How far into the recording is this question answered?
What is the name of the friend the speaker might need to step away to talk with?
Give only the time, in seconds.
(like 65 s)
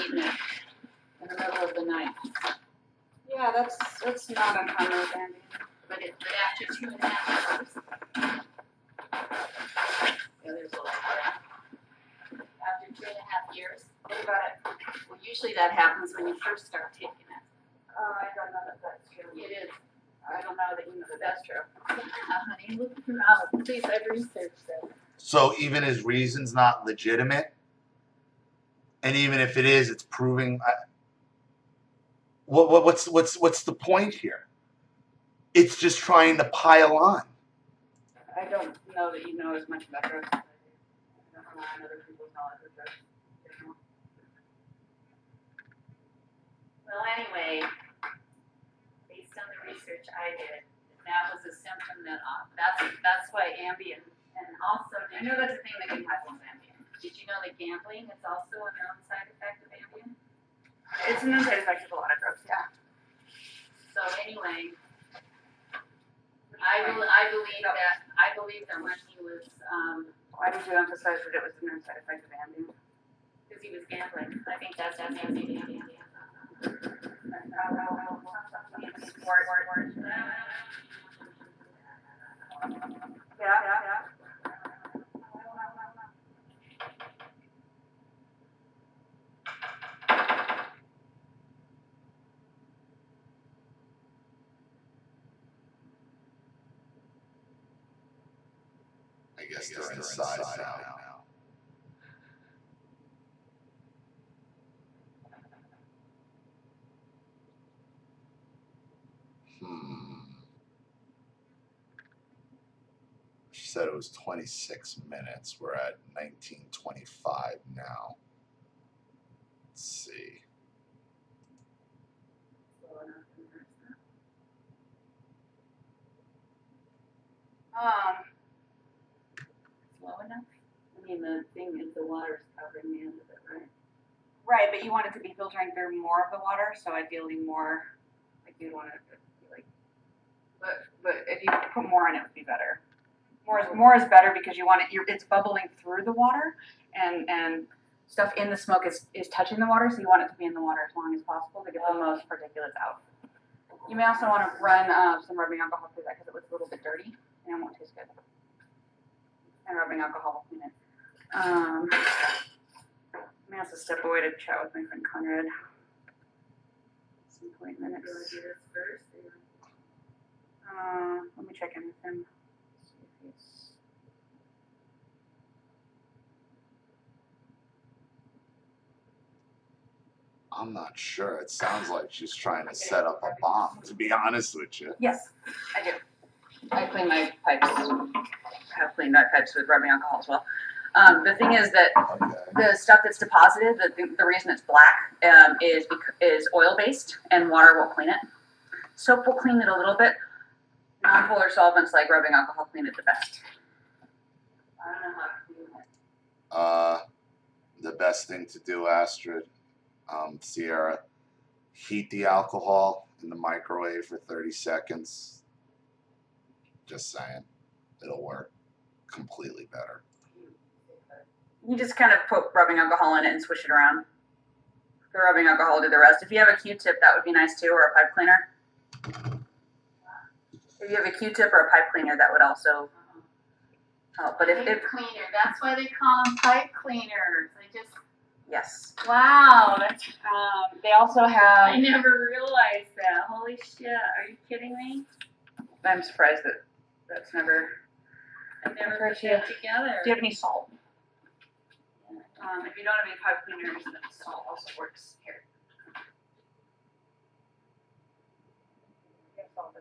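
165 s.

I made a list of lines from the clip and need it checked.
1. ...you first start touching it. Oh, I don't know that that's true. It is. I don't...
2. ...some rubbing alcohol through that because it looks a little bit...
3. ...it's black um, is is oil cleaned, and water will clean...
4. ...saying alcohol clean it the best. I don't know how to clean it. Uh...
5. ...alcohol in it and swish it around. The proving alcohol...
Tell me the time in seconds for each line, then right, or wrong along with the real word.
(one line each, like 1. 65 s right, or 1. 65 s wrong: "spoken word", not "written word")
1. 16 s wrong: "taking", not "touching"
2. 155 s right
3. 194 s wrong: "based", not "cleaned"
4. 202 s wrong: "rubbing", not "saying"
5. 222 s wrong: "rubbing", not "proving".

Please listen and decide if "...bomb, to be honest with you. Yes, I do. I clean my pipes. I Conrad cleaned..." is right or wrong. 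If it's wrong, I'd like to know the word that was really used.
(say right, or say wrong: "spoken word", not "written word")
wrong: "Have", not "Conrad".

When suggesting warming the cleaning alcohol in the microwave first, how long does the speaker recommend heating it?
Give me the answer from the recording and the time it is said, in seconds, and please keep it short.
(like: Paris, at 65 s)
30 seconds, at 214 s.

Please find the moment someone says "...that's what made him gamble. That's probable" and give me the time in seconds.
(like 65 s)
74 s.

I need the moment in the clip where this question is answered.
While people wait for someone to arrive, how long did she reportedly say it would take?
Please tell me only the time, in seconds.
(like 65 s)
114 s.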